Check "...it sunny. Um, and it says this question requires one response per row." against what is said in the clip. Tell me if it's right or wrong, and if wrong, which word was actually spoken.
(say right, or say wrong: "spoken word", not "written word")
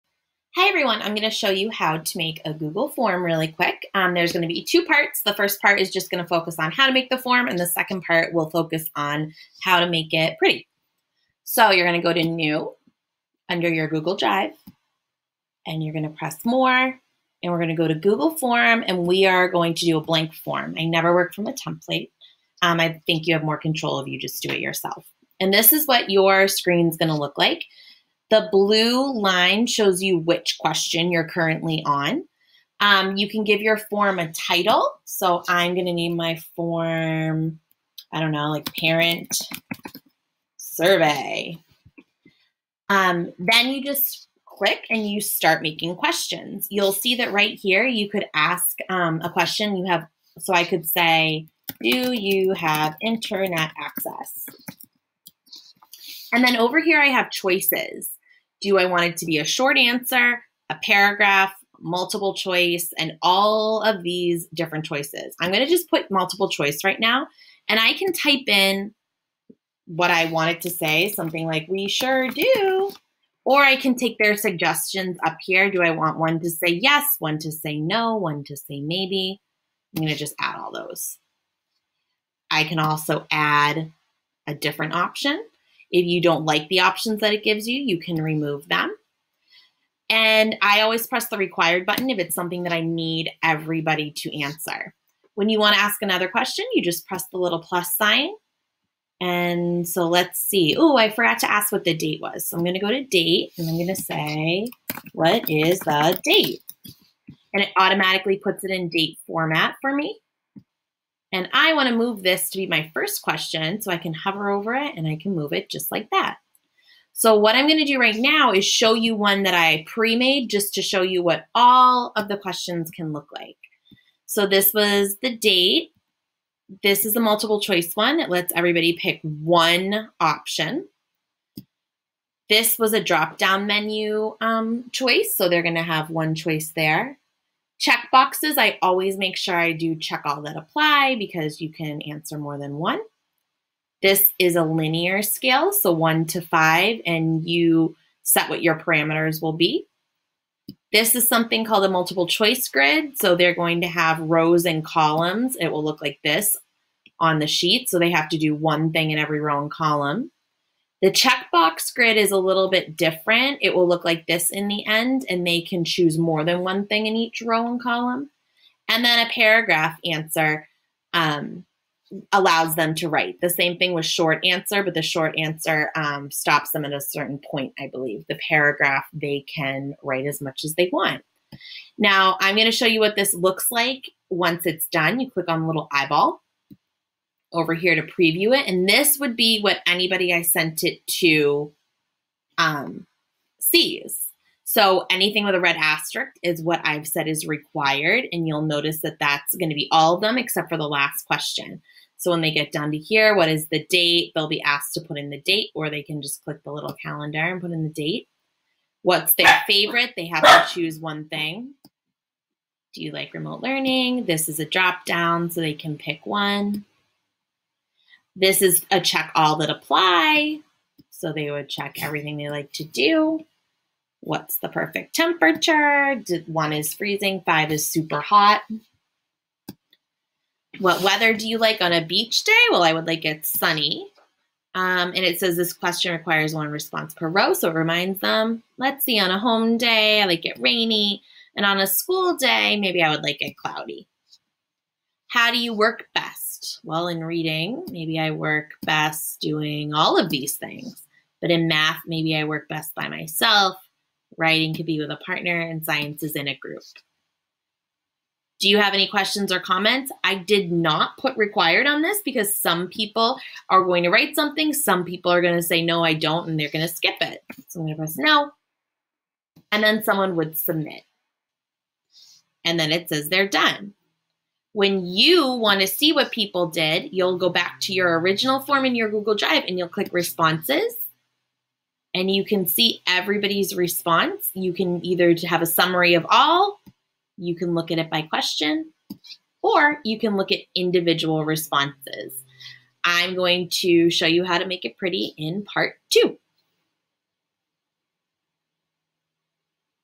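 right.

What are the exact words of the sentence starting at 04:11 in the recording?
But in math, maybe I work best by myself.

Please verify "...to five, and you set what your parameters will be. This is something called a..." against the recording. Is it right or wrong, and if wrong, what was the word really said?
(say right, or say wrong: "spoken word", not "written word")
right.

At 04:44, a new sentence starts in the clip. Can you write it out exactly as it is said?
You can either have a summary of all, you can look at it by question, or you can look at individual responses.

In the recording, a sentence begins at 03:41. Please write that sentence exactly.
So they would check everything they like to do.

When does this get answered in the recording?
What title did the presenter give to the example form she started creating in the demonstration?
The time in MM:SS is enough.
00:38.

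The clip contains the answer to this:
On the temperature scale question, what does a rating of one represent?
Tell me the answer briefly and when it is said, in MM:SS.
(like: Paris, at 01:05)
Freezing, at 03:46.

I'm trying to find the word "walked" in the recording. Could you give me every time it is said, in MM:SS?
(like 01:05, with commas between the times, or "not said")
not said.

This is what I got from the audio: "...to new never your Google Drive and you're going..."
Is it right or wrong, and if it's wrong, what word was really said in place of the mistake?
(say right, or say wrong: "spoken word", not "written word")
wrong: "under", not "never".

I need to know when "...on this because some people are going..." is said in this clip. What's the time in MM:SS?
04:21.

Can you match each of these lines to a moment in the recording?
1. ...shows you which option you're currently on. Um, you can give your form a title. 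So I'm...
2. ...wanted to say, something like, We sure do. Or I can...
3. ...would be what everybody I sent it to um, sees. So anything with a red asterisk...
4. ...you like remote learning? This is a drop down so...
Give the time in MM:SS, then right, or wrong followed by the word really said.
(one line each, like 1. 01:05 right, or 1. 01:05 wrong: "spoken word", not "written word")
1. 00:29 wrong: "question", not "option"
2. 01:10 right
3. 03:09 wrong: "anybody", not "everybody"
4. 03:33 right.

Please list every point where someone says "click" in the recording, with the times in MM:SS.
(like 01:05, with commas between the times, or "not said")
00:44, 03:05, 03:26, 04:39.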